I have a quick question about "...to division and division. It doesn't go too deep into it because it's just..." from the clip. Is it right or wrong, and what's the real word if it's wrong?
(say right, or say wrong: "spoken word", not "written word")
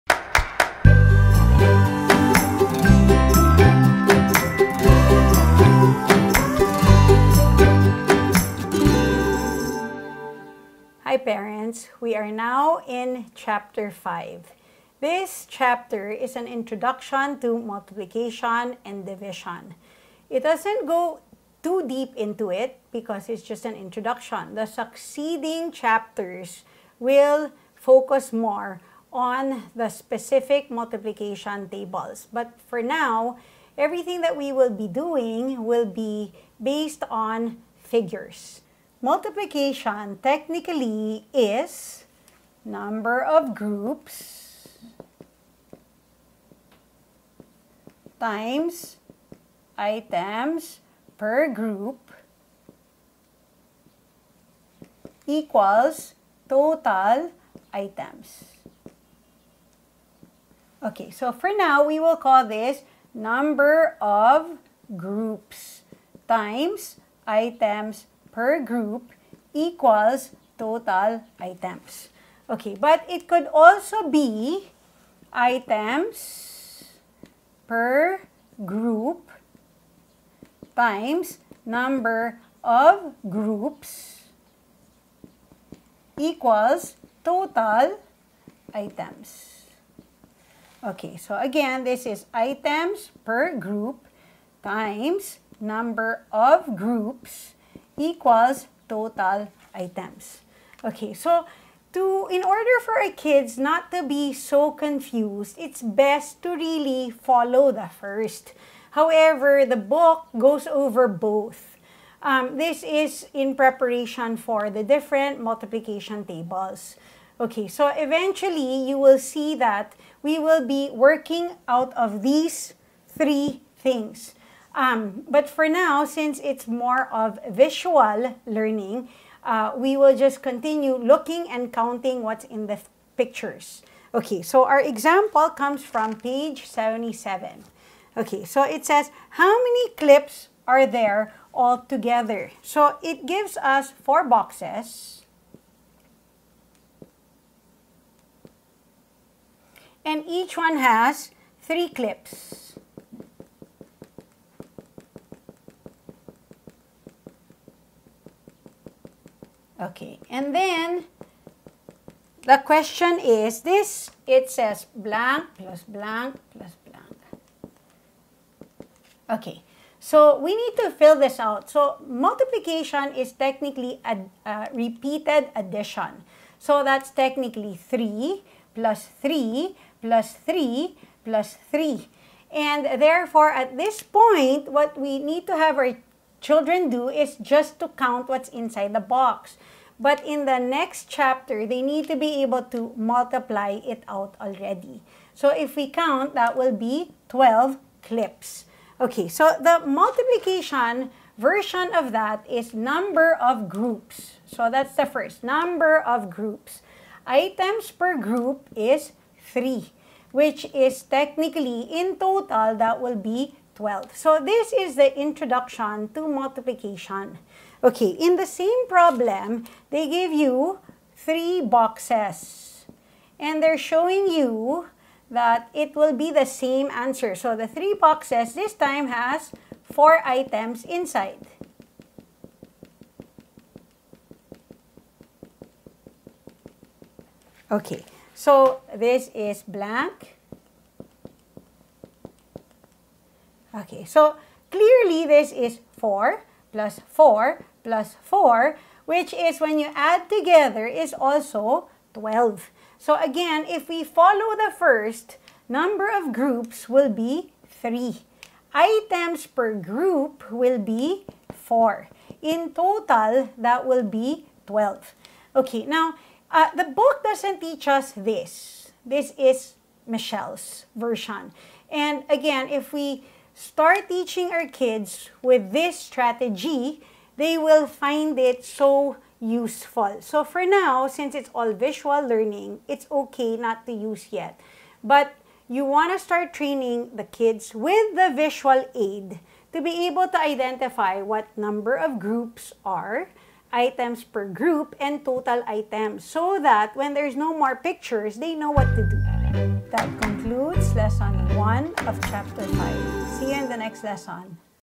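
wrong: "multiplication", not "division".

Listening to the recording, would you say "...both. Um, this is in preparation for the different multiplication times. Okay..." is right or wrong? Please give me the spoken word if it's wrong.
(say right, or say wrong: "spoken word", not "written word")
wrong: "tables", not "times".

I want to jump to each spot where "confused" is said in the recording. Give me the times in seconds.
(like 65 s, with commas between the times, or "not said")
104 s.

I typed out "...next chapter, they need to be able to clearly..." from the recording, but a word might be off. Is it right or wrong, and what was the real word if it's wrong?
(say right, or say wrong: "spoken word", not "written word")
wrong: "multiply", not "clearly".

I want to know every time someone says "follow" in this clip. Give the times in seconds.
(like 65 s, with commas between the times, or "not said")
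107 s, 254 s.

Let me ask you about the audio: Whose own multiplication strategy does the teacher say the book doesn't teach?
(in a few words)
Michelle.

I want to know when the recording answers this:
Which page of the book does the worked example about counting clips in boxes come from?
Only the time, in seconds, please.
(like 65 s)
136 s.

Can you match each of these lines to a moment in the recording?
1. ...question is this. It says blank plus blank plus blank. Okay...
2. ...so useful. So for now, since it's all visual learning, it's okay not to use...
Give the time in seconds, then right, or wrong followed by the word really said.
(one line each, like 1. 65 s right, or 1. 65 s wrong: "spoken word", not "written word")
1. 162 s right
2. 278 s right.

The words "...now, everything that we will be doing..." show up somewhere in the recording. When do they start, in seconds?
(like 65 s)
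32 s.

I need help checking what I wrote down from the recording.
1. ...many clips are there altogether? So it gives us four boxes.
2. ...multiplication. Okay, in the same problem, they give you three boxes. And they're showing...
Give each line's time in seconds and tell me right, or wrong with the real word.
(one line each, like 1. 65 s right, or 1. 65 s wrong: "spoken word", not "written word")
1. 139 s right
2. 216 s right.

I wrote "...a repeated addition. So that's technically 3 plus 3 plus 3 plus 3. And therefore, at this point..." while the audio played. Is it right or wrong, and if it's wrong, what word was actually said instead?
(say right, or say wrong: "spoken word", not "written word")
right.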